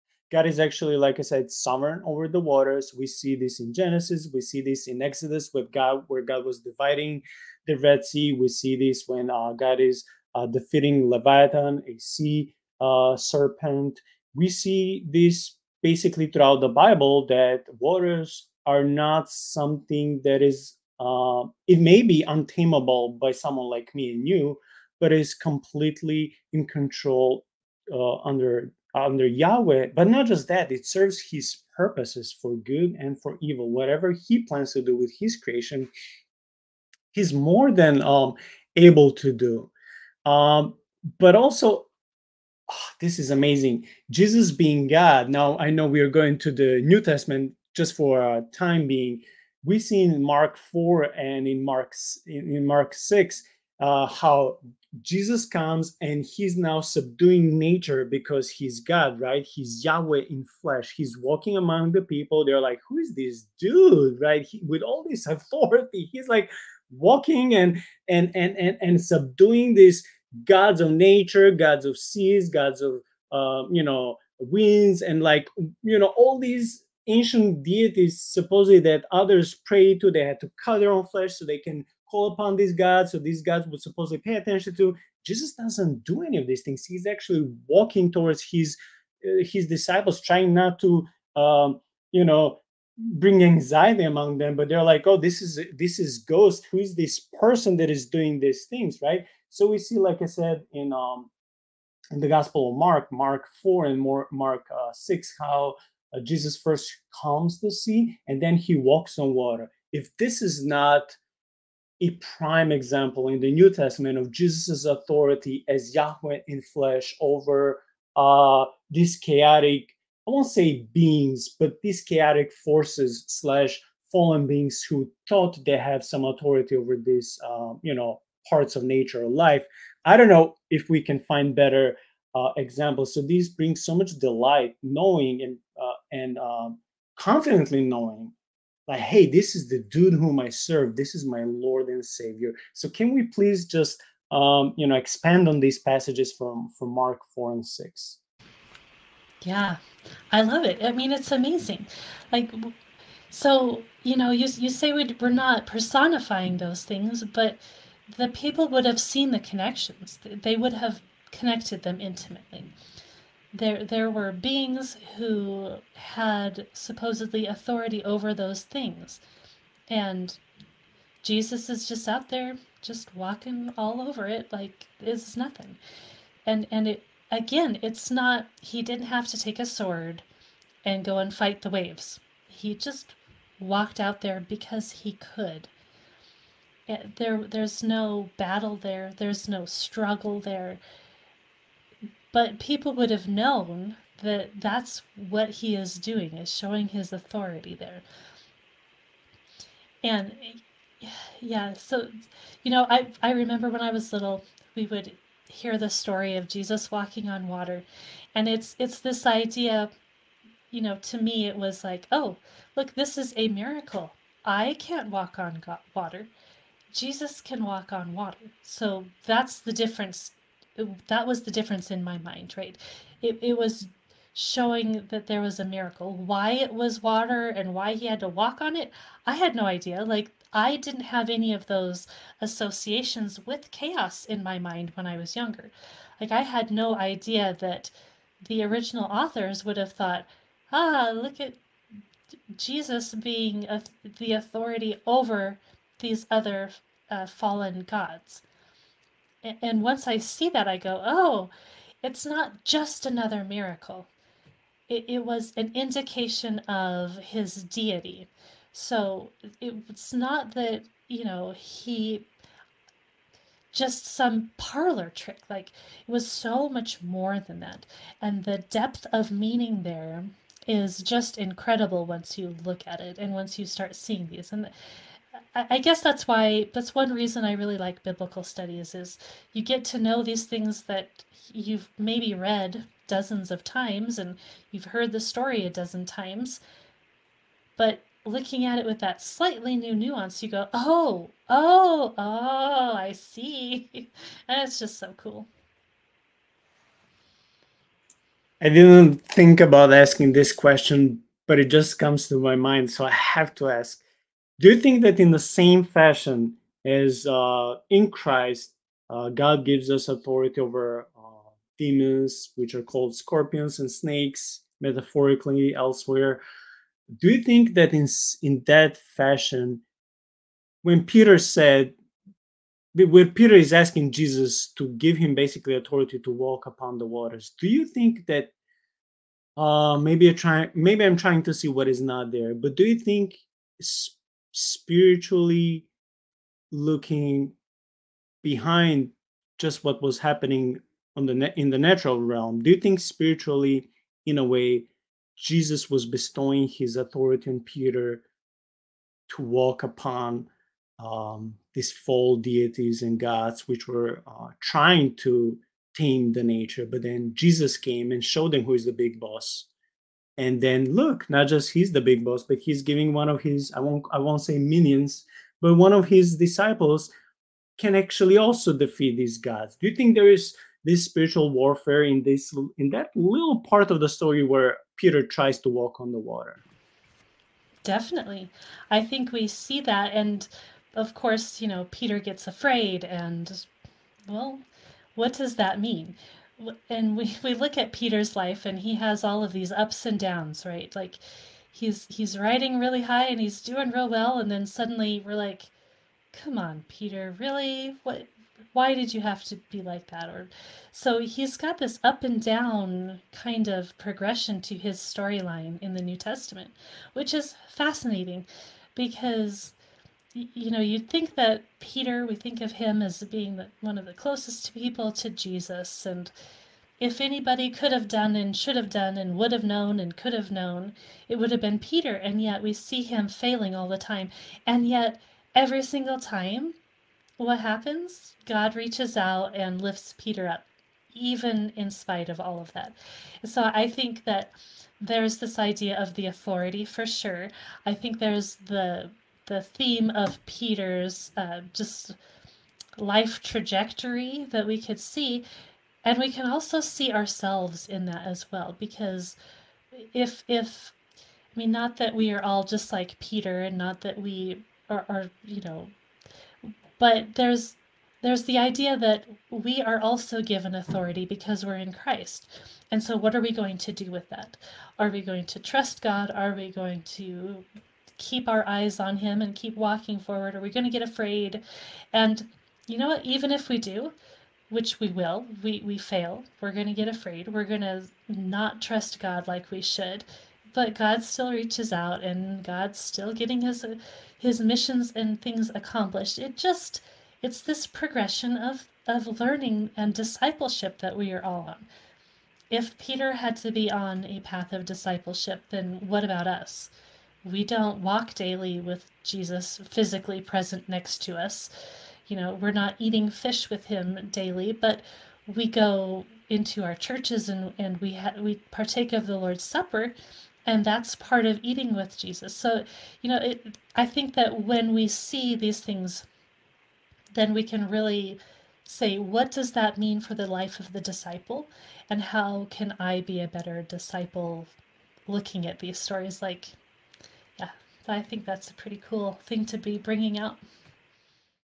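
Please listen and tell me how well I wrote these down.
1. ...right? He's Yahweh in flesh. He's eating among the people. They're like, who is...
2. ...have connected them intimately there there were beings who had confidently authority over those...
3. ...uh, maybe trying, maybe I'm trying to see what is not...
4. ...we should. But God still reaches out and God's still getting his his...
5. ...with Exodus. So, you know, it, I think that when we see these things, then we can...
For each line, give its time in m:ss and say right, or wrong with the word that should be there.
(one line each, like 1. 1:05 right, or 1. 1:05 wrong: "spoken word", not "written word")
1. 0:59 wrong: "walking", not "eating"
2. 2:40 wrong: "supposedly", not "confidently"
3. 5:29 right
4. 7:59 right
5. 8:31 wrong: "Jesus", not "Exodus".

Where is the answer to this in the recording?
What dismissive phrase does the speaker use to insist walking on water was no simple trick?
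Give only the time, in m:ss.
4:24.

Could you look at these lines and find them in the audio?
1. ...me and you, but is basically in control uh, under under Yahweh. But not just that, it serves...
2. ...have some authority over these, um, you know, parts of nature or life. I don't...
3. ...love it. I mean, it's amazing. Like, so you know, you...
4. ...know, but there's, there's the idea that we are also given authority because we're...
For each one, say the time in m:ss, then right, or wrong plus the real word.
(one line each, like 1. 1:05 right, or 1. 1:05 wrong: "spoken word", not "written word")
1. 0:23 wrong: "completely", not "basically"
2. 2:05 right
3. 2:30 right
4. 7:35 right.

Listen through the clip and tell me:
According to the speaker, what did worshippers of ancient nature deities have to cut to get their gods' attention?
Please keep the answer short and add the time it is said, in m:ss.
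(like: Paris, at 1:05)
Their own flesh, at 1:20.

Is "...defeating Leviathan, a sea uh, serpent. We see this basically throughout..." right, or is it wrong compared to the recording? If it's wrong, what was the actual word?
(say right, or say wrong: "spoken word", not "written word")
right.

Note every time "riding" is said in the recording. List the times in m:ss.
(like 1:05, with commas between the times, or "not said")
6:32.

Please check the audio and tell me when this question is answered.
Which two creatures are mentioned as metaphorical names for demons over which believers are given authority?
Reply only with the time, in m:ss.
5:13.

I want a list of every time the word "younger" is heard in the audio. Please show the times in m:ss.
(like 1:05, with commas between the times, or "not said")
3:55.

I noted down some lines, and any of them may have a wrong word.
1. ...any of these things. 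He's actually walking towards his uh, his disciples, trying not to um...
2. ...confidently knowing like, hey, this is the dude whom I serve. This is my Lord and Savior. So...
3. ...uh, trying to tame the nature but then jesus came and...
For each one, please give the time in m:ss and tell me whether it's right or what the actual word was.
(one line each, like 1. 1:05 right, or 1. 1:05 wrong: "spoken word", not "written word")
1. 1:26 right
2. 2:17 right
3. 5:54 right.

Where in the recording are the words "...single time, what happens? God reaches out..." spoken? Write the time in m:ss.
7:05.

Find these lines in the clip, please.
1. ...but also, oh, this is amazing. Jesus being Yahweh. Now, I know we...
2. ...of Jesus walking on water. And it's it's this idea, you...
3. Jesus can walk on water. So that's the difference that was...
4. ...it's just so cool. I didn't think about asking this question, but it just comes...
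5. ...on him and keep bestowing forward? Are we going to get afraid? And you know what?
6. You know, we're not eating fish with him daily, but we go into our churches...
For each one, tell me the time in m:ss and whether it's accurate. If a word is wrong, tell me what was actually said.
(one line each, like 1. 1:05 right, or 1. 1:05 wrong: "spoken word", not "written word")
1. 0:41 wrong: "God", not "Yahweh"
2. 3:26 right
3. 3:36 right
4. 4:54 right
5. 7:48 wrong: "walking", not "bestowing"
6. 8:22 right.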